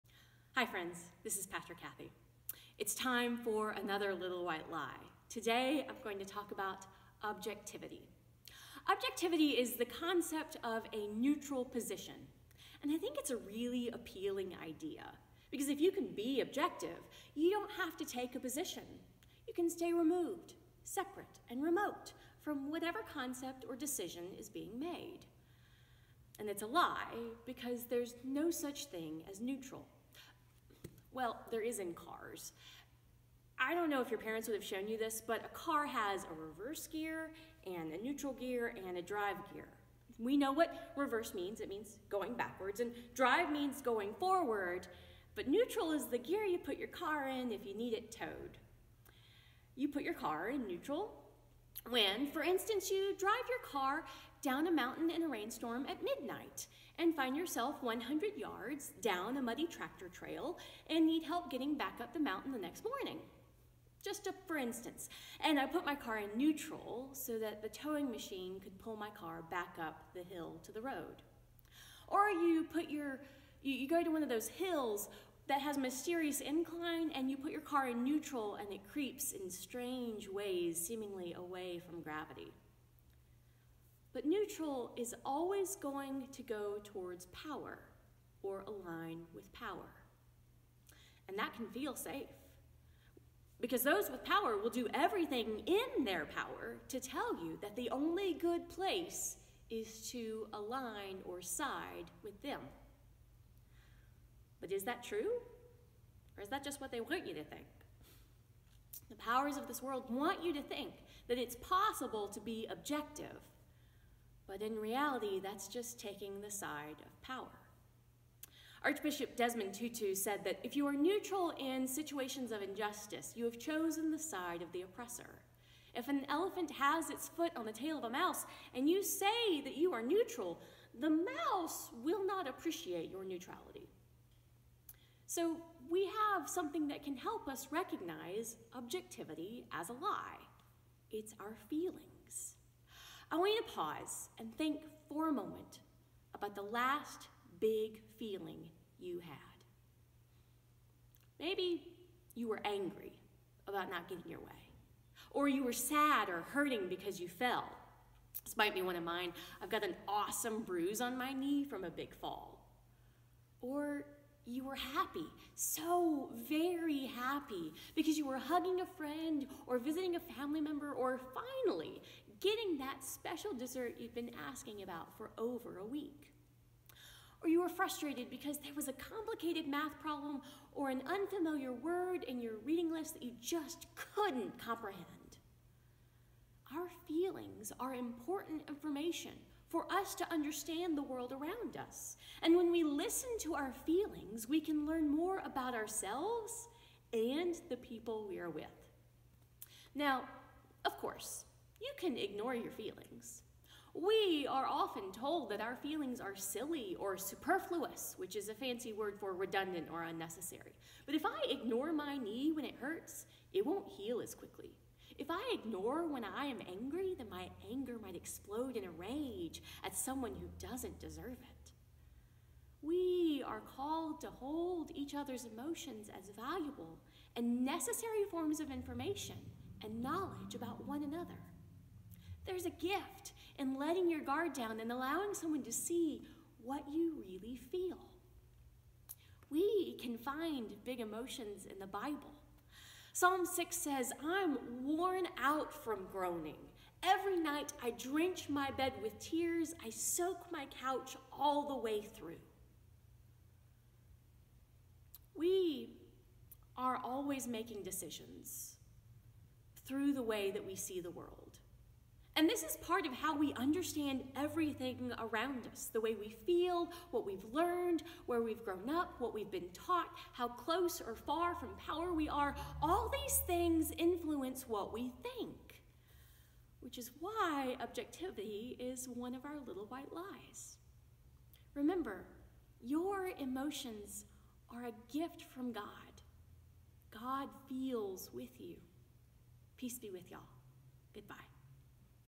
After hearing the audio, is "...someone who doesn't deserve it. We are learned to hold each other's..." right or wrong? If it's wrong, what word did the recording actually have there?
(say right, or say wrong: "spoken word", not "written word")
wrong: "called", not "learned".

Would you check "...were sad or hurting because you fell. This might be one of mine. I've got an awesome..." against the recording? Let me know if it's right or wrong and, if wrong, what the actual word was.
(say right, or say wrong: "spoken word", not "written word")
right.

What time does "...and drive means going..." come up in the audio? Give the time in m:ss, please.
0:42.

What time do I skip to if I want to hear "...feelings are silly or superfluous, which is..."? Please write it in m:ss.
3:25.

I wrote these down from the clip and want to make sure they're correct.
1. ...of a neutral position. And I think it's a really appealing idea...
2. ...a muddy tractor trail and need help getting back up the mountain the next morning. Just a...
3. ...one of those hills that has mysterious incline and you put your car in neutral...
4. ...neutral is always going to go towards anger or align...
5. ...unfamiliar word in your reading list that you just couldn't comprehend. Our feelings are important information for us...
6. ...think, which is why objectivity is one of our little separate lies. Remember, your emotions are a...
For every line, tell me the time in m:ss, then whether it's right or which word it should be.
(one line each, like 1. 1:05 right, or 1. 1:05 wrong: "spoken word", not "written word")
1. 0:10 right
2. 0:59 right
3. 1:14 right
4. 1:24 wrong: "power", not "anger"
5. 3:01 right
6. 4:35 wrong: "white", not "separate".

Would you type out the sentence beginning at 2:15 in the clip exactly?
So we have something that can help us recognize objectivity as a lie.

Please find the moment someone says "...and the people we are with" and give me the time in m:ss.
3:17.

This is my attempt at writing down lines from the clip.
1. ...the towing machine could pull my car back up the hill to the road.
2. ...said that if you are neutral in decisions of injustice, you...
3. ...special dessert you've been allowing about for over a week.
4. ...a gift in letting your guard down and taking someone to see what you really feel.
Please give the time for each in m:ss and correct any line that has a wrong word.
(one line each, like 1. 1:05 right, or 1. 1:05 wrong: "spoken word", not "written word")
1. 1:07 right
2. 2:00 wrong: "situations", not "decisions"
3. 2:53 wrong: "asking", not "allowing"
4. 3:52 wrong: "allowing", not "taking".